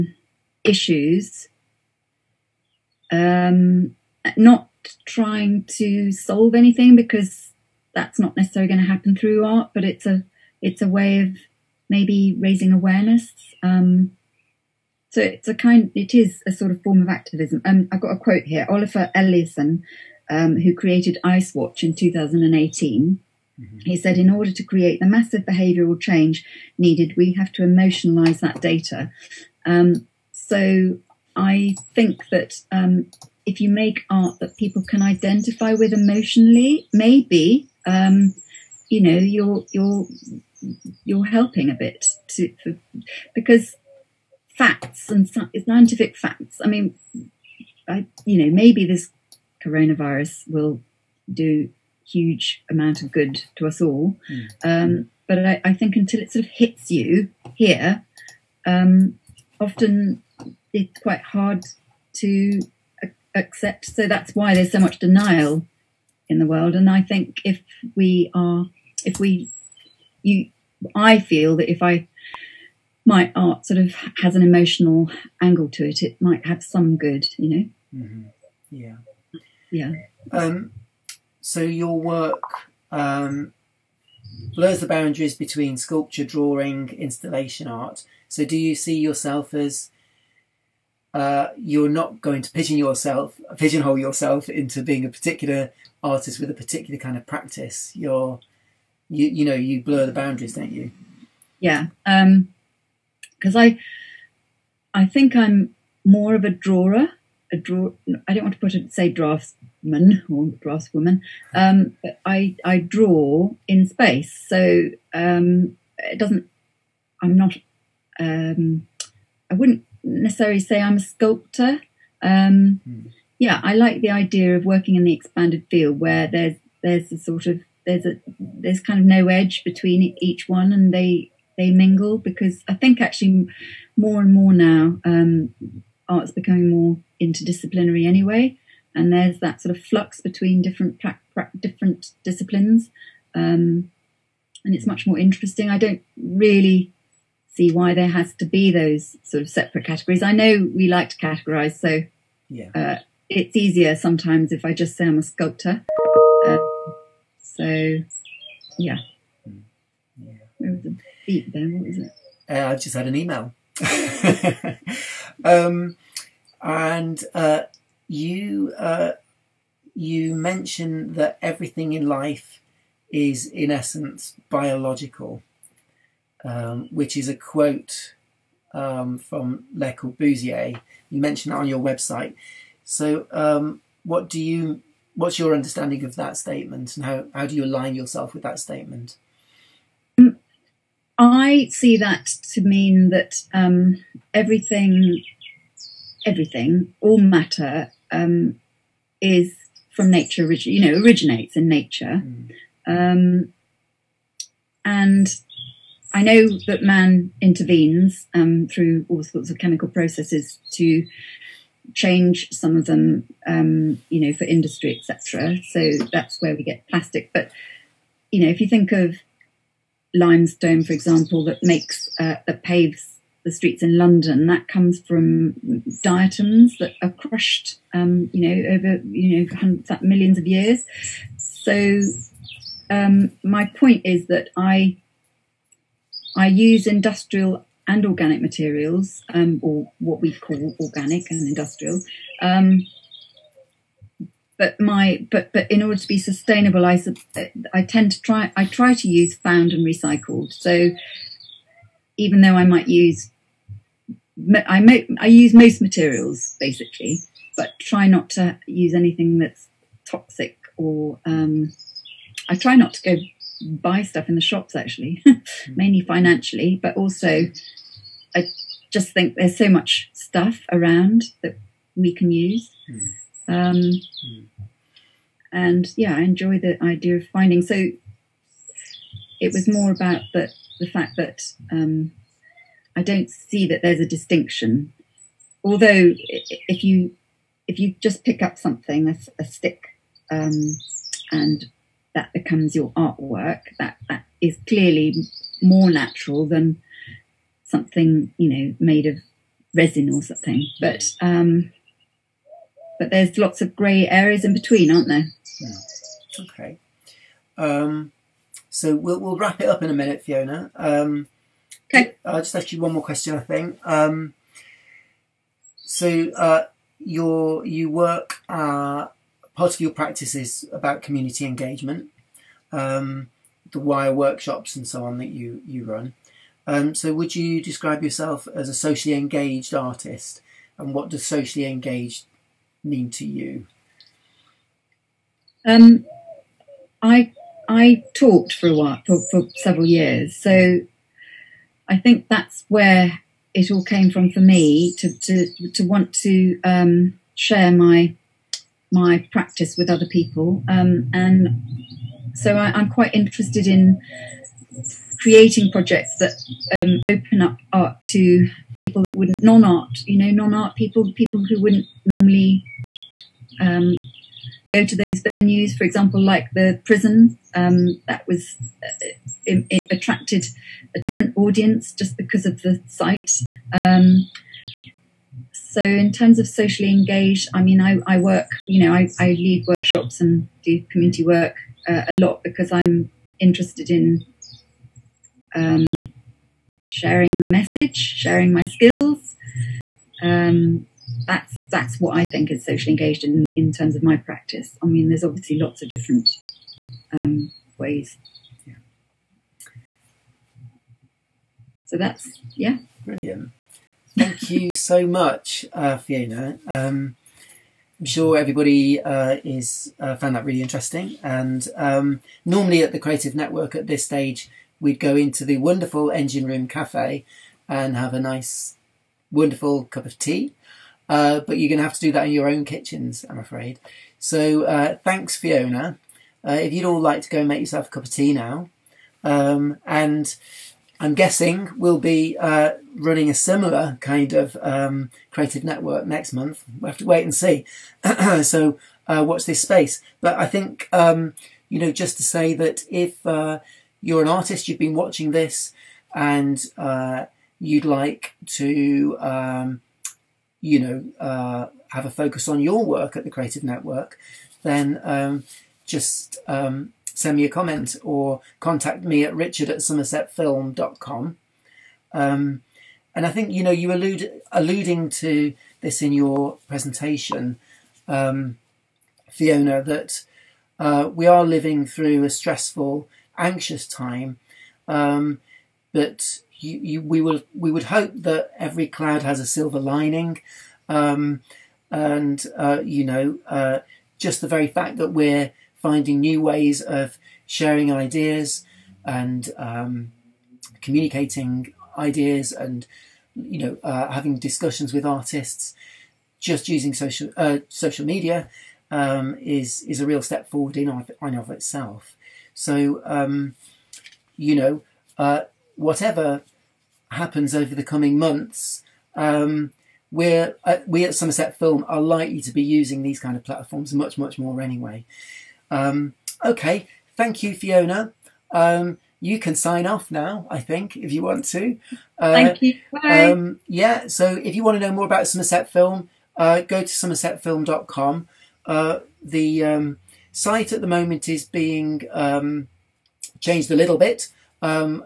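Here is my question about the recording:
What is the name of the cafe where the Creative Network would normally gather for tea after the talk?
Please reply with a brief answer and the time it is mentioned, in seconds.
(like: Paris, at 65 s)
Engine Room Cafe, at 416 s.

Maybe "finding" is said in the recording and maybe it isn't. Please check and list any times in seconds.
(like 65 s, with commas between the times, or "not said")
277 s, 485 s.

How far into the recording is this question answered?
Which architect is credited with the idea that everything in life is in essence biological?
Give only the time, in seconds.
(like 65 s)
179 s.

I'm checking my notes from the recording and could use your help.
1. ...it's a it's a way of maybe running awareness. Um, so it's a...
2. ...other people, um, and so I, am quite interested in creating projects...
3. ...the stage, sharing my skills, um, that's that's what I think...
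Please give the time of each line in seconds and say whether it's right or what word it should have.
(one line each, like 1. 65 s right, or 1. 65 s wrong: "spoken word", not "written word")
1. 9 s wrong: "raising", not "running"
2. 349 s right
3. 387 s wrong: "message", not "stage".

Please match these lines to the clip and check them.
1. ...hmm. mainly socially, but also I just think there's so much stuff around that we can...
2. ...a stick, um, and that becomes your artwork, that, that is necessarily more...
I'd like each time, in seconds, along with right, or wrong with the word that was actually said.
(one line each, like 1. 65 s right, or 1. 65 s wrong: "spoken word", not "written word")
1. 265 s wrong: "financially", not "socially"
2. 289 s wrong: "clearly", not "necessarily".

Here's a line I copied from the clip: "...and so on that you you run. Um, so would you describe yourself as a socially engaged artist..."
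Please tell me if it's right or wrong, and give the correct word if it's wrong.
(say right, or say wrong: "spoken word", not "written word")
right.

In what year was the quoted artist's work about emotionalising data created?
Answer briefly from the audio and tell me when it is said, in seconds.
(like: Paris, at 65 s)
2018, at 21 s.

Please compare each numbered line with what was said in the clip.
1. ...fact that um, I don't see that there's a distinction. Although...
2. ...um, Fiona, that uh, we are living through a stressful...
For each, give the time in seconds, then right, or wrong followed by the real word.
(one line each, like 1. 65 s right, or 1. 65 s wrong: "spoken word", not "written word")
1. 280 s right
2. 468 s right.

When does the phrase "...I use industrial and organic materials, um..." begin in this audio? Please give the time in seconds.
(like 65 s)
236 s.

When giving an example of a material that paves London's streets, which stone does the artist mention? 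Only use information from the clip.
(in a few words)
Limestone.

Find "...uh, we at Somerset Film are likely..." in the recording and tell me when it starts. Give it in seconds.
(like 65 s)
510 s.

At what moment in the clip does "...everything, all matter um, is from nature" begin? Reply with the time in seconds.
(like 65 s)
196 s.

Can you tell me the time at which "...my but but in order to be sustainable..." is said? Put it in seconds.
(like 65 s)
244 s.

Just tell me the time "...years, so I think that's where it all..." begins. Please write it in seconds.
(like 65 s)
339 s.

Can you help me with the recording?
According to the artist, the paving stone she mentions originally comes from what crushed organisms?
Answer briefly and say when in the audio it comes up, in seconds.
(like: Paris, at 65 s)
Diatoms, at 226 s.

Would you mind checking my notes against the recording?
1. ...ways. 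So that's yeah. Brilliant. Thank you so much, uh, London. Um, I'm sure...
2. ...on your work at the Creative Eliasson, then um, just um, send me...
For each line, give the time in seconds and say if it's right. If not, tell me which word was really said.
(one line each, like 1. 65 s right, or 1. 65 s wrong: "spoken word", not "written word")
1. 397 s wrong: "Fiona", not "London"
2. 452 s wrong: "Network", not "Eliasson".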